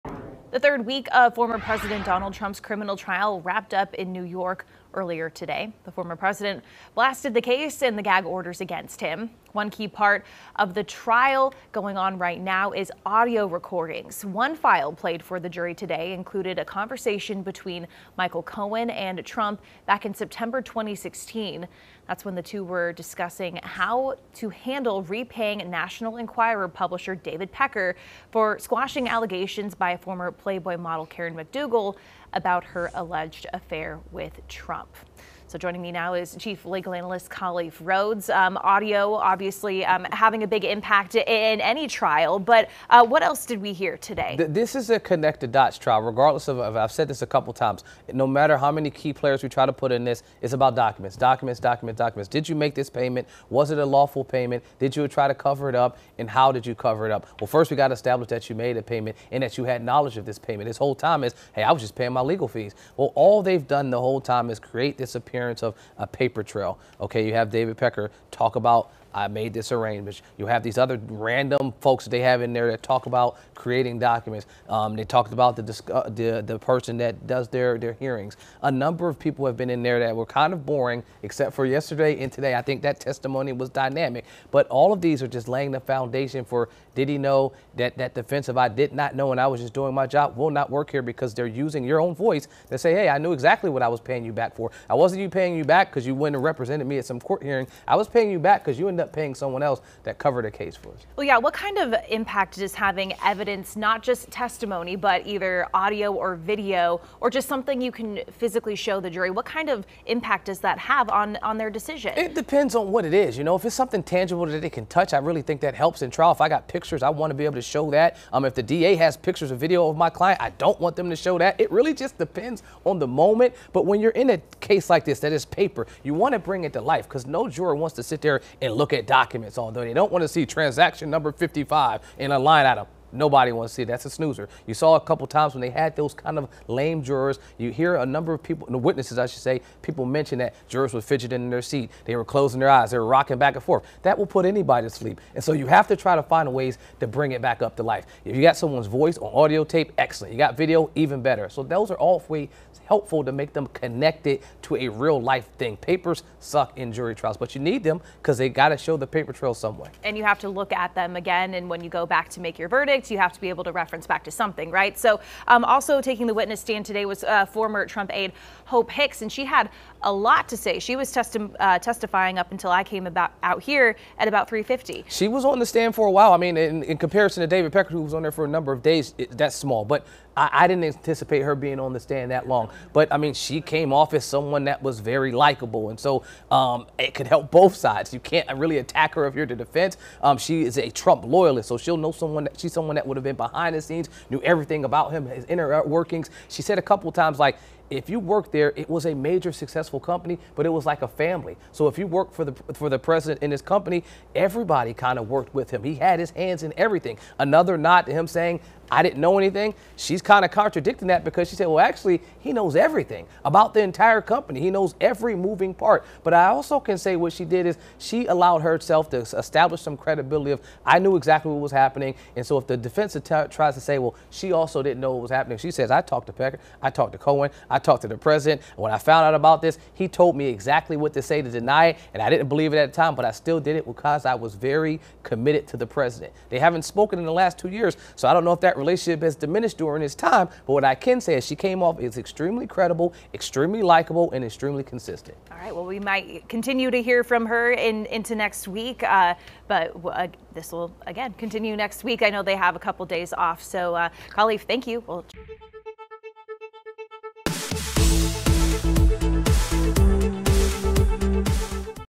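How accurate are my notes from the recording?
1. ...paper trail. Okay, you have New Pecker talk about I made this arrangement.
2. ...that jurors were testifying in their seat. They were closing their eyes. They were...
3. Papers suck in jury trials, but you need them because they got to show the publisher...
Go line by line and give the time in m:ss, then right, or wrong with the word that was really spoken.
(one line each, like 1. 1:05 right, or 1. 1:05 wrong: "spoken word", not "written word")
1. 1:06 wrong: "David", not "New"
2. 2:20 wrong: "fidgeting", not "testifying"
3. 2:35 wrong: "paper", not "publisher".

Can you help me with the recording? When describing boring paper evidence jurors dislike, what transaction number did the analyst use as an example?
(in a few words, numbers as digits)
55.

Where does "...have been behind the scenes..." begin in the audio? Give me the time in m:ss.
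3:13.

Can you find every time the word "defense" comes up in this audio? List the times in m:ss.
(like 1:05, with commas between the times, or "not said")
1:28, 3:09, 3:42.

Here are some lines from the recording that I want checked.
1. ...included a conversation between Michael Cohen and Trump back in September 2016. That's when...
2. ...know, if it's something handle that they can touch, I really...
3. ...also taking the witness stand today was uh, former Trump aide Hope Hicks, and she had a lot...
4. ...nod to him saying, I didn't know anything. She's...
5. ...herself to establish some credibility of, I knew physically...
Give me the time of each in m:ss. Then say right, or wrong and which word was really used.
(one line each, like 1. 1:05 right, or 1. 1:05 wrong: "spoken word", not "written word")
1. 0:16 right
2. 1:53 wrong: "tangible", not "handle"
3. 2:45 right
4. 3:27 right
5. 3:38 wrong: "exactly", not "physically".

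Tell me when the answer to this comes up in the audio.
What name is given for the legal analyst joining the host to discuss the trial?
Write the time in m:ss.
0:37.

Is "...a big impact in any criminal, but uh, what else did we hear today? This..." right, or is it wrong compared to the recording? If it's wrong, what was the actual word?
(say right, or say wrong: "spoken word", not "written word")
wrong: "trial", not "criminal".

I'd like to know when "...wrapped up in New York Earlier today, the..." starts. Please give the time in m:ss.
0:03.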